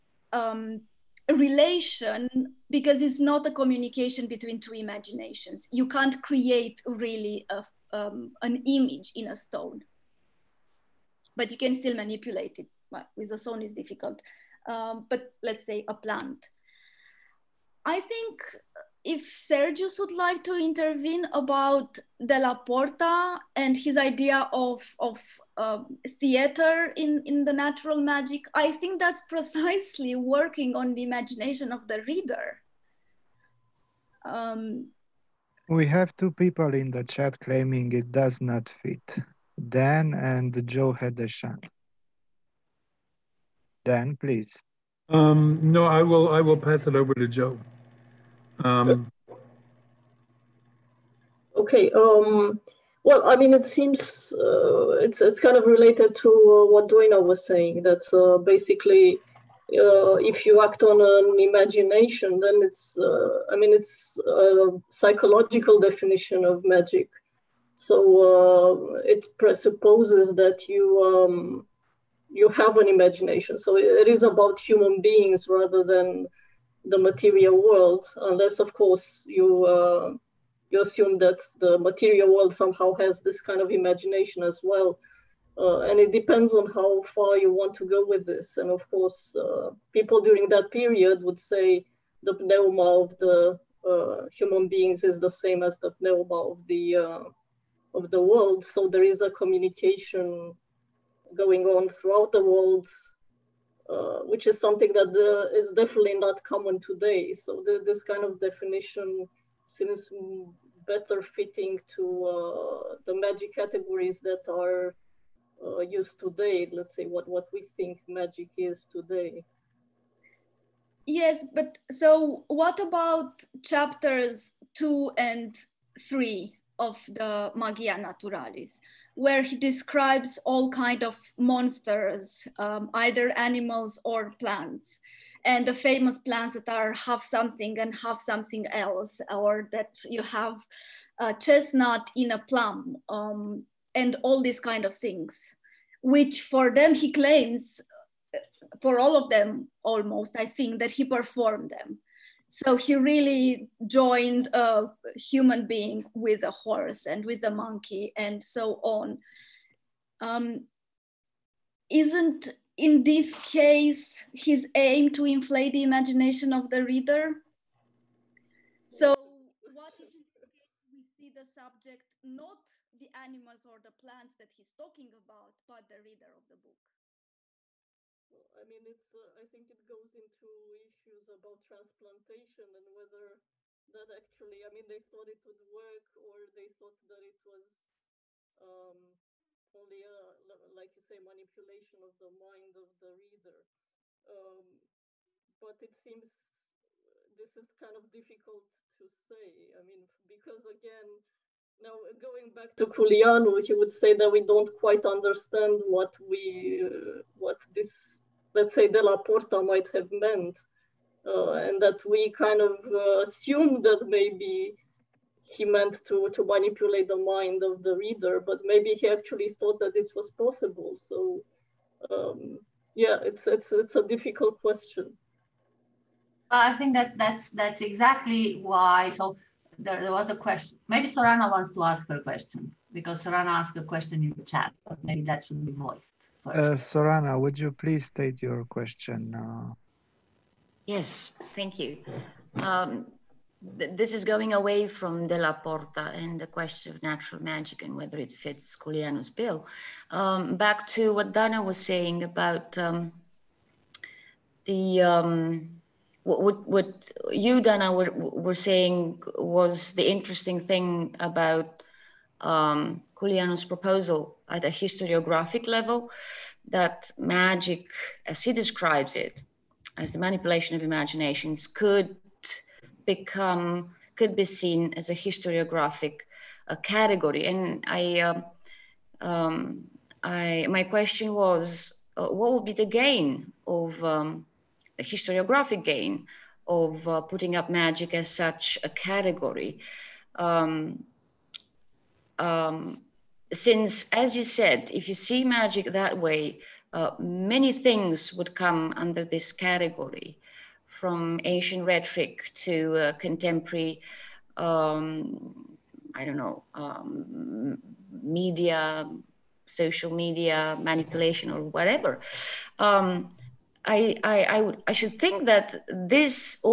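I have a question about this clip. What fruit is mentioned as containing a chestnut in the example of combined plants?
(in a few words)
a plum.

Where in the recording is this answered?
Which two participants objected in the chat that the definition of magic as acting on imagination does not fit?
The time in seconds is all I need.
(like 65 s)
39 s.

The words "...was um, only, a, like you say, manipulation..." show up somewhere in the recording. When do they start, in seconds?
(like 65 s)
187 s.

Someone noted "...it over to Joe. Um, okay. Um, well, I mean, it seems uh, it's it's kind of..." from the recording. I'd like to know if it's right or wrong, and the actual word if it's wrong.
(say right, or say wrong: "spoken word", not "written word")
right.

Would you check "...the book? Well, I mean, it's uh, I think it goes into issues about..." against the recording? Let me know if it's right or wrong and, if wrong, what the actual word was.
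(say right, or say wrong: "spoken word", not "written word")
right.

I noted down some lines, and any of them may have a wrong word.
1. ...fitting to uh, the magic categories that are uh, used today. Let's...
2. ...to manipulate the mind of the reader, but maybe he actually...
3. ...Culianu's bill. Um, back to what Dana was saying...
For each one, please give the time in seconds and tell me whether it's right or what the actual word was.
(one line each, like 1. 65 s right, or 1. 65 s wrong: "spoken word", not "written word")
1. 111 s right
2. 216 s right
3. 248 s right.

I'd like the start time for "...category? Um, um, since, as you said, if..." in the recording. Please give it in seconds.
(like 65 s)
288 s.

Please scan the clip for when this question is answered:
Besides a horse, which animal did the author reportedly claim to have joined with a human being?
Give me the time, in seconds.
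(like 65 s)
157 s.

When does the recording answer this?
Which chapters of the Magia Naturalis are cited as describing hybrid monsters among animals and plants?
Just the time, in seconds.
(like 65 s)
123 s.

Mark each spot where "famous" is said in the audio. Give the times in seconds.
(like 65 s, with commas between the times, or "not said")
135 s.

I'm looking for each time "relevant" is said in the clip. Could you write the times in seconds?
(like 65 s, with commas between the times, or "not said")
not said.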